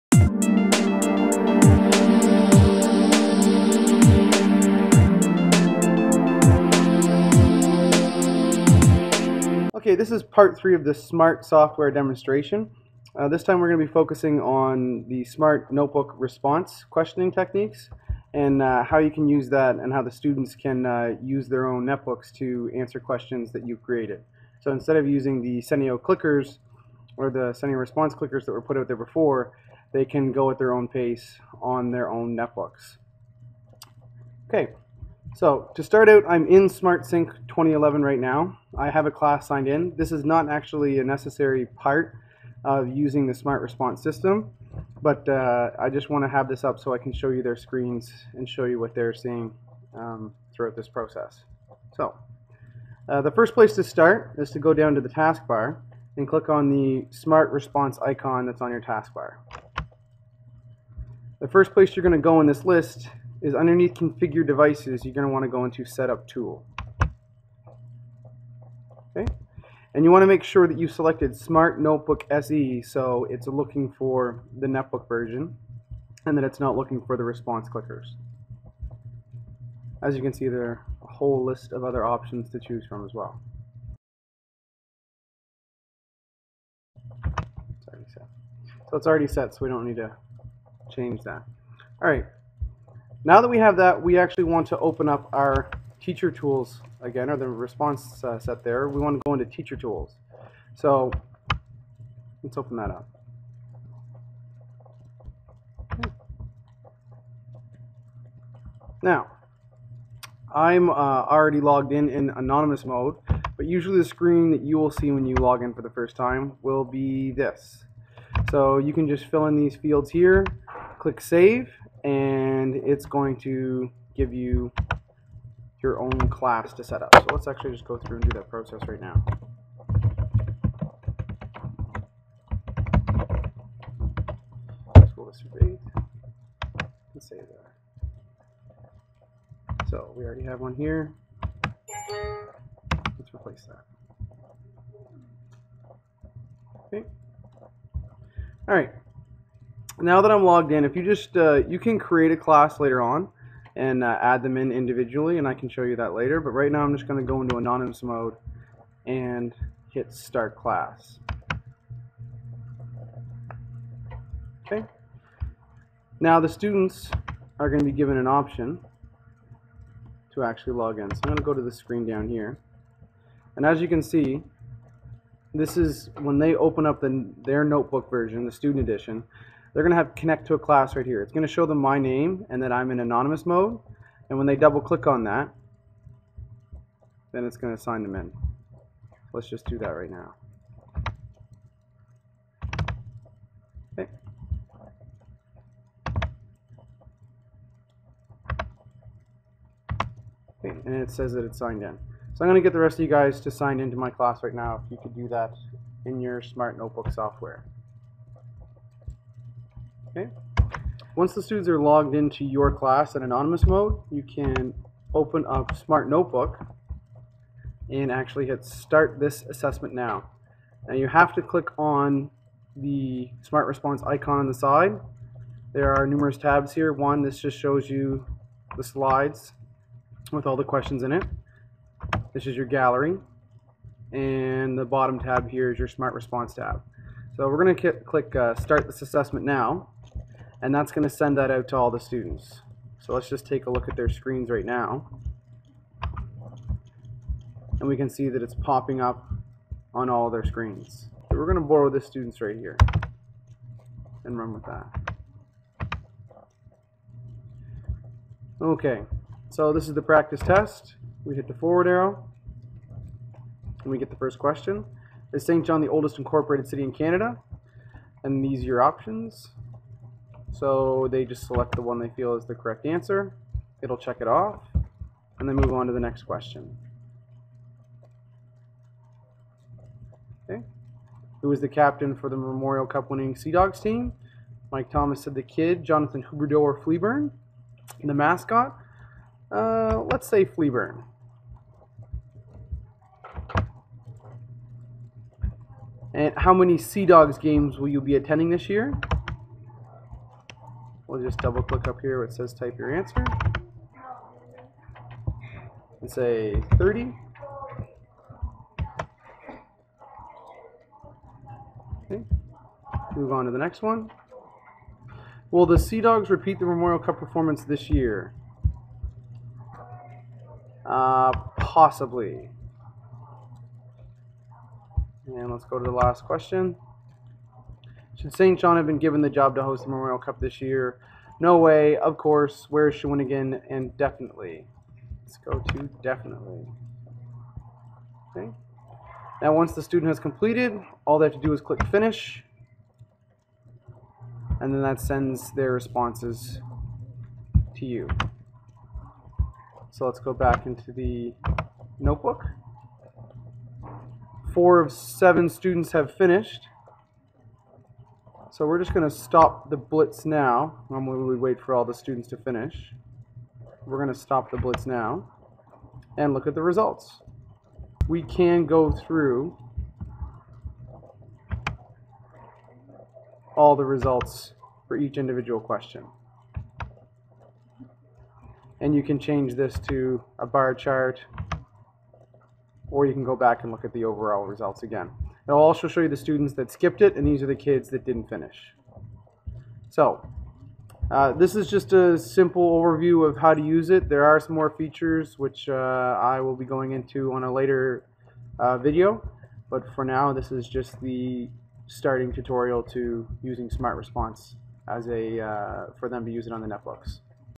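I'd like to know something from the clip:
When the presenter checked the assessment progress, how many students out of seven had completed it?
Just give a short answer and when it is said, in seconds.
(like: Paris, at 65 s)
Four, at 354 s.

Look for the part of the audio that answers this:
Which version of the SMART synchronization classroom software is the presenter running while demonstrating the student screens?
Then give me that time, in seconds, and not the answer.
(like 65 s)
36 s.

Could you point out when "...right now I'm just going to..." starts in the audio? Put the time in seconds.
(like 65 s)
156 s.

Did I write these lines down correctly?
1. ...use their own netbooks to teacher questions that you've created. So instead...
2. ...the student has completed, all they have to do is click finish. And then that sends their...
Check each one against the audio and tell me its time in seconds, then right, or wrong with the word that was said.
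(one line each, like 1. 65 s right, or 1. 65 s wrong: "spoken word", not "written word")
1. 21 s wrong: "answer", not "teacher"
2. 339 s right.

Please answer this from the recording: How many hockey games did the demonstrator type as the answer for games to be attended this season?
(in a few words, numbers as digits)
30.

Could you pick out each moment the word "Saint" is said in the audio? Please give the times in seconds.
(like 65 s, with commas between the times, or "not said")
265 s, 328 s.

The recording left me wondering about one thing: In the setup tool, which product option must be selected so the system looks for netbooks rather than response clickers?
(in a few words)
Smart Notebook SE.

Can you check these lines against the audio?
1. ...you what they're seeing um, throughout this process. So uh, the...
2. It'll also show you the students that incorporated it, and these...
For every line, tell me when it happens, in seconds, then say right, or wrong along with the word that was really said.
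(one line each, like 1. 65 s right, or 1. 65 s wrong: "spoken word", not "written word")
1. 48 s right
2. 385 s wrong: "skipped", not "incorporated".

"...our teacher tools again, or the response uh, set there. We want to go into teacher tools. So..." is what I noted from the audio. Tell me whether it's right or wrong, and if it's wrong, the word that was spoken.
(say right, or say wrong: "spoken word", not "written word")
right.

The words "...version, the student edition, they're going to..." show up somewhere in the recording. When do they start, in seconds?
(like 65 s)
178 s.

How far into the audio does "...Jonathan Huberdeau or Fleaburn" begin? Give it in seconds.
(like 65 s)
285 s.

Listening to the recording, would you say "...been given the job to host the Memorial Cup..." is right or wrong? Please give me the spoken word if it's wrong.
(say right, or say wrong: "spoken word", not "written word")
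right.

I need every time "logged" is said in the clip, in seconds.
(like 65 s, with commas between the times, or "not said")
111 s, 150 s, 211 s.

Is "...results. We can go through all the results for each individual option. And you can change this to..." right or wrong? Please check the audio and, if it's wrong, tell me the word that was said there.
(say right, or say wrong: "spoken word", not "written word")
wrong: "question", not "option".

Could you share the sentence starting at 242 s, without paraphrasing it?
So let's just take a look at their screens right now.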